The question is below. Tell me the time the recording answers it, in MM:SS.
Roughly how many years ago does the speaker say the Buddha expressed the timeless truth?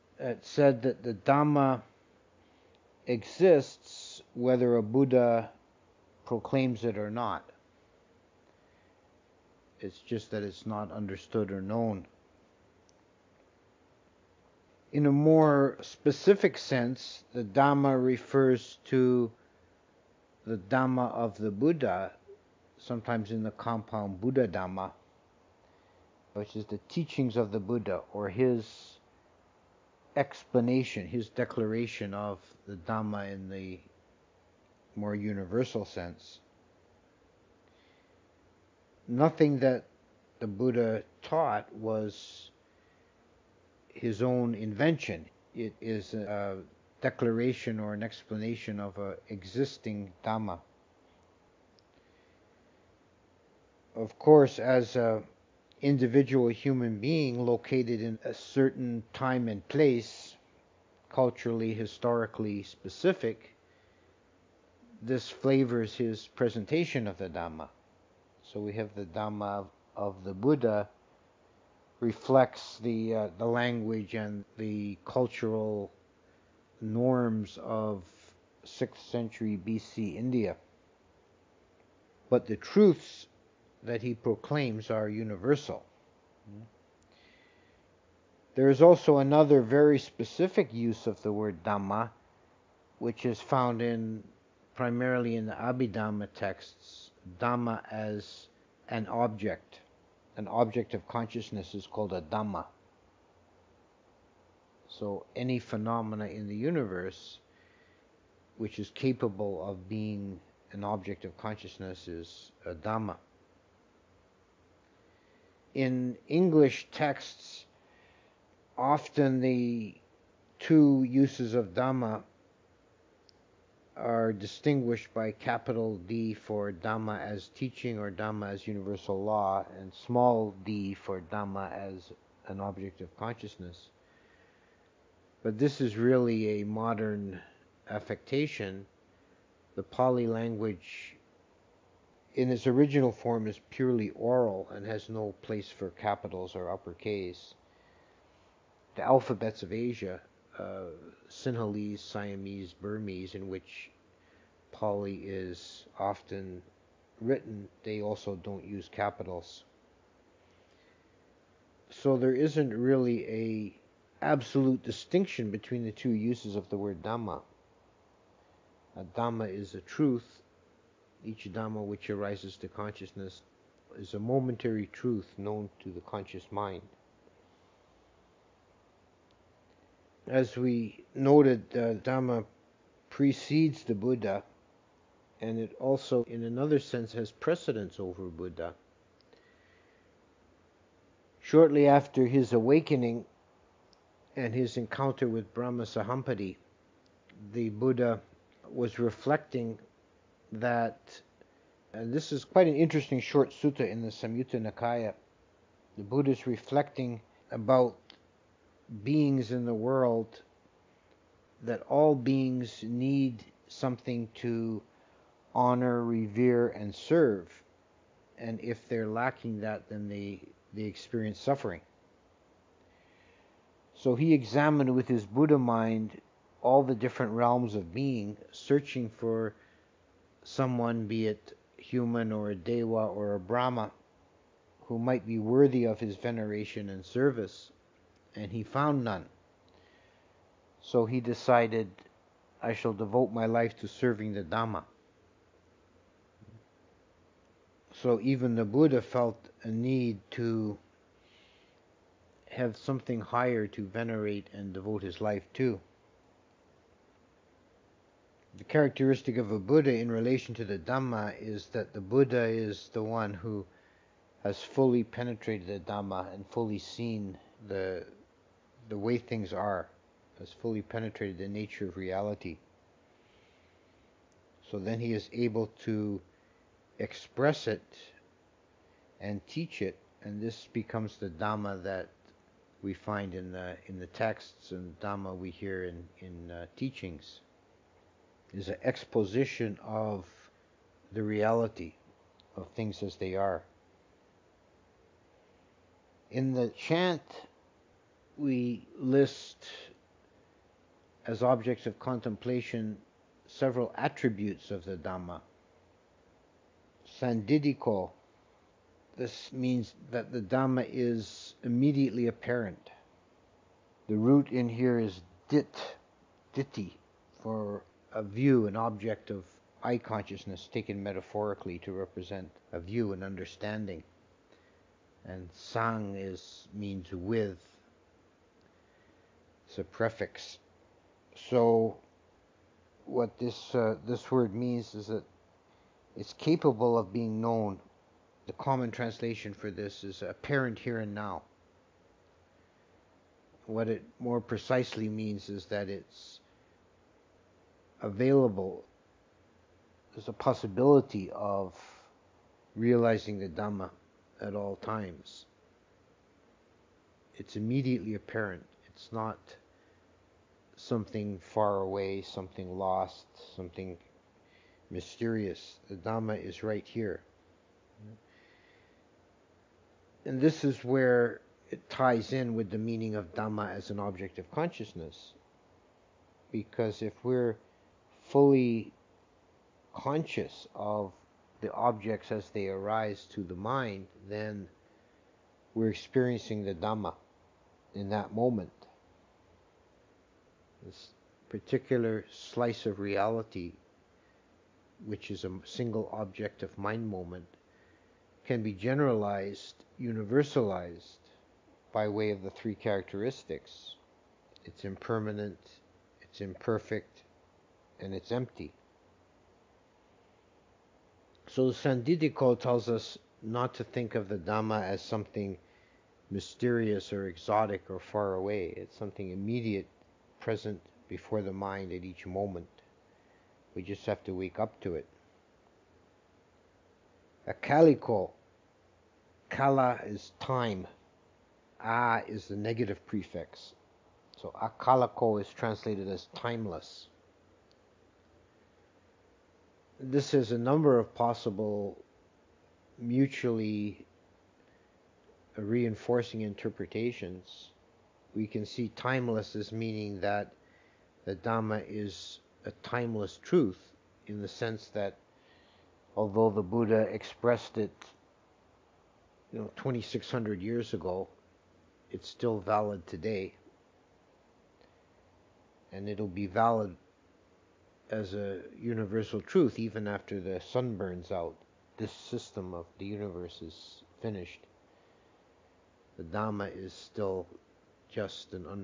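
07:39.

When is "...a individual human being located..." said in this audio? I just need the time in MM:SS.
00:54.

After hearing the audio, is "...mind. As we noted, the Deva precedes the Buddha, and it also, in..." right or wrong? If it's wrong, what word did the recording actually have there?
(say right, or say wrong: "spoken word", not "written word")
wrong: "Dhamma", not "Deva".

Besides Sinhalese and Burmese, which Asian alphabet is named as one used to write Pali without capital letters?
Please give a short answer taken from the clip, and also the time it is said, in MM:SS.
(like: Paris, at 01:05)
Siamese, at 02:32.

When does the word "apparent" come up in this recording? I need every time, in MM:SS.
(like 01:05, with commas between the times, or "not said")
05:12, 05:40, 05:58.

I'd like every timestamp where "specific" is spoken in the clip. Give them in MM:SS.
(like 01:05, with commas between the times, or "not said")
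00:15, 01:02, 01:29.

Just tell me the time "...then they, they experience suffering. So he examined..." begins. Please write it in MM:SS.
03:39.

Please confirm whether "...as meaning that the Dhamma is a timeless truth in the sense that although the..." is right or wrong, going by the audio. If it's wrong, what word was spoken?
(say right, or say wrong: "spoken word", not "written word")
right.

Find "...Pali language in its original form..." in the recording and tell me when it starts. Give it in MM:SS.
02:19.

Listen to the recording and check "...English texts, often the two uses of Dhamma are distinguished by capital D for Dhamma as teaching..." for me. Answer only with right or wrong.
right.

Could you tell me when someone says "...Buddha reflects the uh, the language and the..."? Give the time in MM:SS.
01:10.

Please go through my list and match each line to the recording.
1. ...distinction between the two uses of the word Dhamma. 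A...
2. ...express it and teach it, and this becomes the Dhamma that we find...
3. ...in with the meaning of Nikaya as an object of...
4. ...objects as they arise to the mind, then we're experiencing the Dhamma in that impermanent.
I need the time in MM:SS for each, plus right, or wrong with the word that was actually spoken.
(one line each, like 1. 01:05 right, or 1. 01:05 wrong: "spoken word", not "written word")
1. 02:44 right
2. 04:36 right
3. 06:12 wrong: "Dhamma", not "Nikaya"
4. 06:21 wrong: "moment", not "impermanent".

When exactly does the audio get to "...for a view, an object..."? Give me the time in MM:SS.
05:17.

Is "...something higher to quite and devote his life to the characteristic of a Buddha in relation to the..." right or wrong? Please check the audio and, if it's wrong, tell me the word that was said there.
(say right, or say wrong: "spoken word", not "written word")
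wrong: "venerate", not "quite".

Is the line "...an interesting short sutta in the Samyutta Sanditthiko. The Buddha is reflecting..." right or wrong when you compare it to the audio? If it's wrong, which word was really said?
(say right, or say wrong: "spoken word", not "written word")
wrong: "Nikaya", not "Sanditthiko".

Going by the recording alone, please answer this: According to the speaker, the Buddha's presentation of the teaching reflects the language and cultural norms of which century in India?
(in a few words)
6th century BC.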